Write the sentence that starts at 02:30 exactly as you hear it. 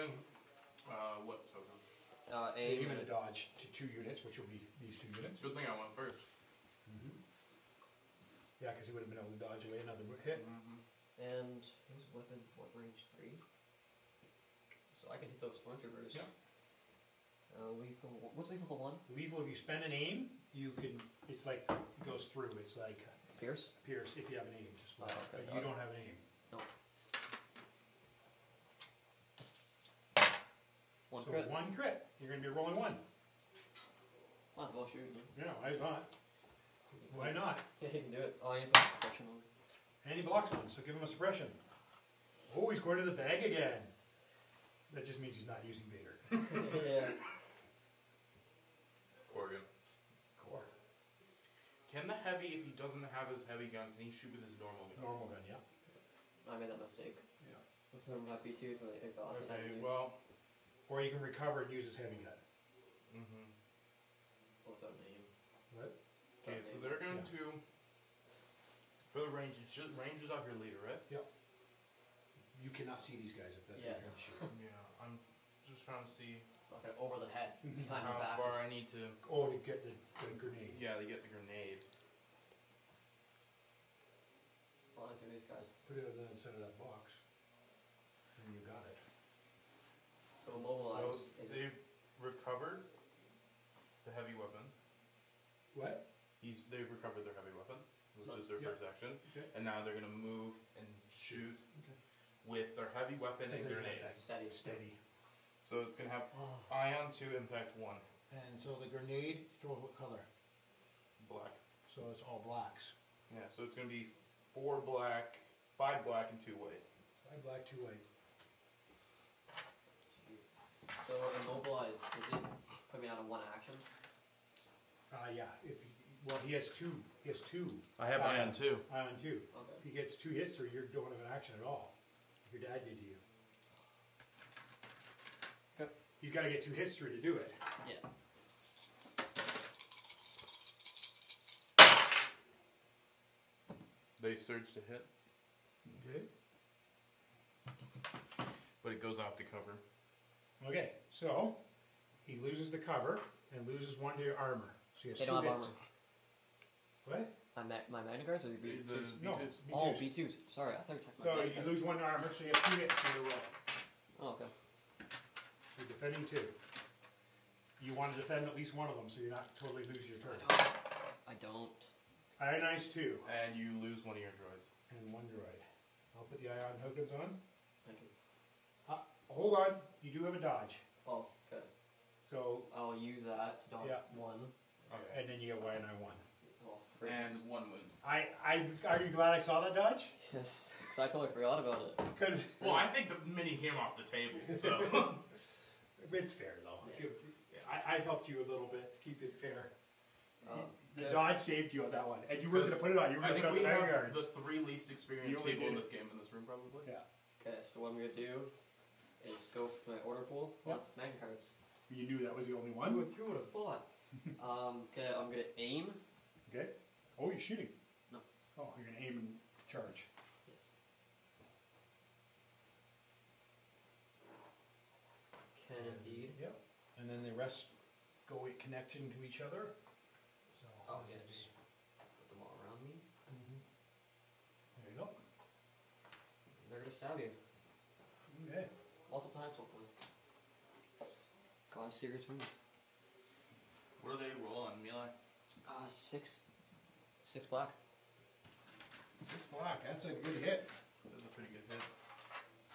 Okay, so he loses the cover and loses one to your armor.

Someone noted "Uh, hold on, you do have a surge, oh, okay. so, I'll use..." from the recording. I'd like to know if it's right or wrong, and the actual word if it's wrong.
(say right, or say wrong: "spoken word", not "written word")
wrong: "dodge", not "surge".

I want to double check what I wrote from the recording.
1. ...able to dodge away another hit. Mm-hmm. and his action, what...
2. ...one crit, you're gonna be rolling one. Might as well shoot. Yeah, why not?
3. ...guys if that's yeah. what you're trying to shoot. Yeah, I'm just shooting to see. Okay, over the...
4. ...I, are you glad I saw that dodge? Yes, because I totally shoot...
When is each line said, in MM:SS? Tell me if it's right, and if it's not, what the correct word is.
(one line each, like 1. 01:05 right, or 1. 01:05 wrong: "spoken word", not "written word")
1. 00:09 wrong: "weapon", not "action"
2. 00:31 right
3. 01:13 wrong: "trying", not "shooting"
4. 03:08 wrong: "forgot", not "shoot".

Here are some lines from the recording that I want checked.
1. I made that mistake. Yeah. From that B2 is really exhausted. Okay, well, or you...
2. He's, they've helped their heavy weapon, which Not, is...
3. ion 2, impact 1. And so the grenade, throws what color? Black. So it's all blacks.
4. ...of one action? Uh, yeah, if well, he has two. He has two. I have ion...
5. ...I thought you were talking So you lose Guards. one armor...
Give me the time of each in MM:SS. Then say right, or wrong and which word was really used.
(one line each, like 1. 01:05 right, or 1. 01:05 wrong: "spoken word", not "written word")
1. 00:56 right
2. 01:36 wrong: "recovered", not "helped"
3. 01:46 right
4. 02:03 right
5. 02:40 right.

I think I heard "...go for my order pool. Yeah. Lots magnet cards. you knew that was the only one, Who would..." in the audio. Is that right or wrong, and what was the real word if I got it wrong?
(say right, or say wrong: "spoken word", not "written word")
right.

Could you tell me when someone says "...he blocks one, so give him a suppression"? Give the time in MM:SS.
00:40.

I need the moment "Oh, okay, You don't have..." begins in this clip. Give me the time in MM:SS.
00:25.